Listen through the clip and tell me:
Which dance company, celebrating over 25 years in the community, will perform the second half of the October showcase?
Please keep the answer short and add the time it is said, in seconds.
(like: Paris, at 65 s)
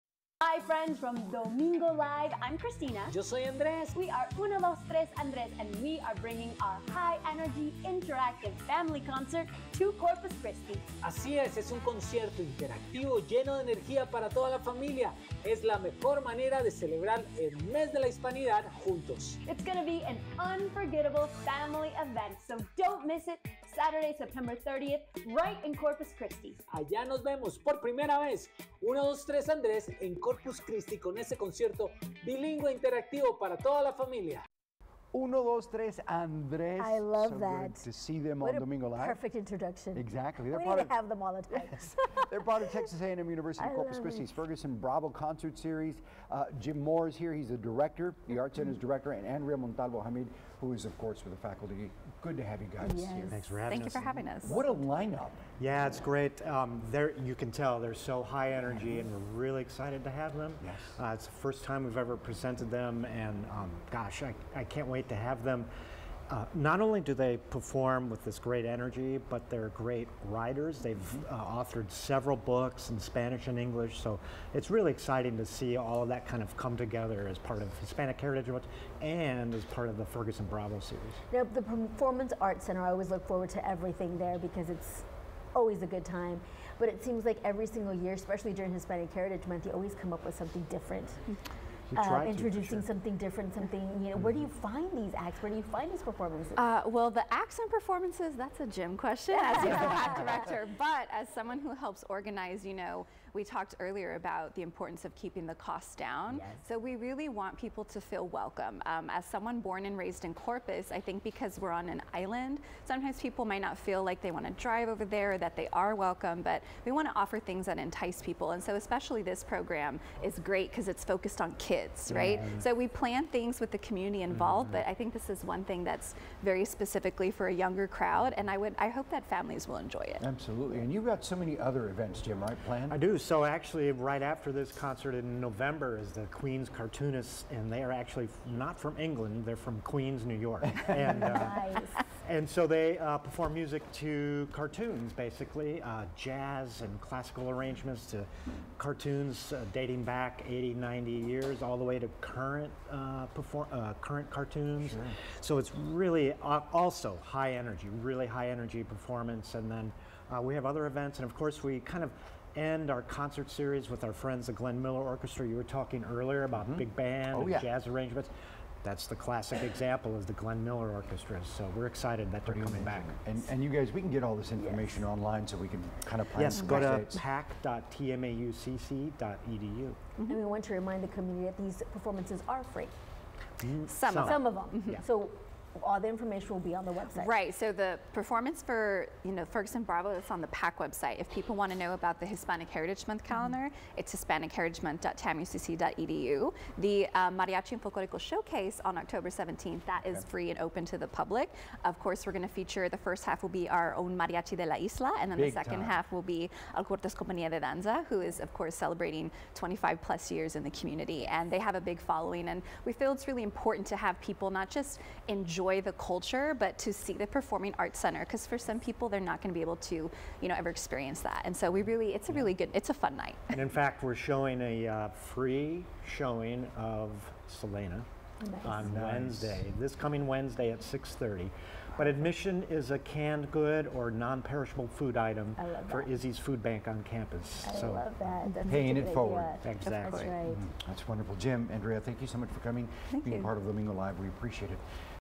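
Alcortes Compañía de Danza, at 206 s.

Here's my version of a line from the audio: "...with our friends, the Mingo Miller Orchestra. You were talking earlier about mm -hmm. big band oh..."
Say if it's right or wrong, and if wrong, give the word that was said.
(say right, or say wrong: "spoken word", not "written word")
wrong: "Glenn", not "Mingo".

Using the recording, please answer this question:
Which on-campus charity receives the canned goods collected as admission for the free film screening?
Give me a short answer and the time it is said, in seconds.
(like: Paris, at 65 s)
Izzy's Food Bank, at 236 s.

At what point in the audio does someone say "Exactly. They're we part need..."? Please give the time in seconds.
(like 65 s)
39 s.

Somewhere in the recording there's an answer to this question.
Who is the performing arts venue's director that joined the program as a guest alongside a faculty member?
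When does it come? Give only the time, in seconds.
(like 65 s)
46 s.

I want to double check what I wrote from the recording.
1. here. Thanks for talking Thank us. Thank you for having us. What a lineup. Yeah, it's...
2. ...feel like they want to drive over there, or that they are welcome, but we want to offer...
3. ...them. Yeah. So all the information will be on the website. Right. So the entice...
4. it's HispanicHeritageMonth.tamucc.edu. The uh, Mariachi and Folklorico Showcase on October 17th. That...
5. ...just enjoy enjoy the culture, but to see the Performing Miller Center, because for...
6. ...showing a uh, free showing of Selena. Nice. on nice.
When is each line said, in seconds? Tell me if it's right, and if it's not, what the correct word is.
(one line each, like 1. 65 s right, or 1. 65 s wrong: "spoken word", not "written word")
1. 53 s wrong: "having", not "talking"
2. 113 s right
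3. 184 s wrong: "performance", not "entice"
4. 193 s right
5. 214 s wrong: "Arts", not "Miller"
6. 224 s right.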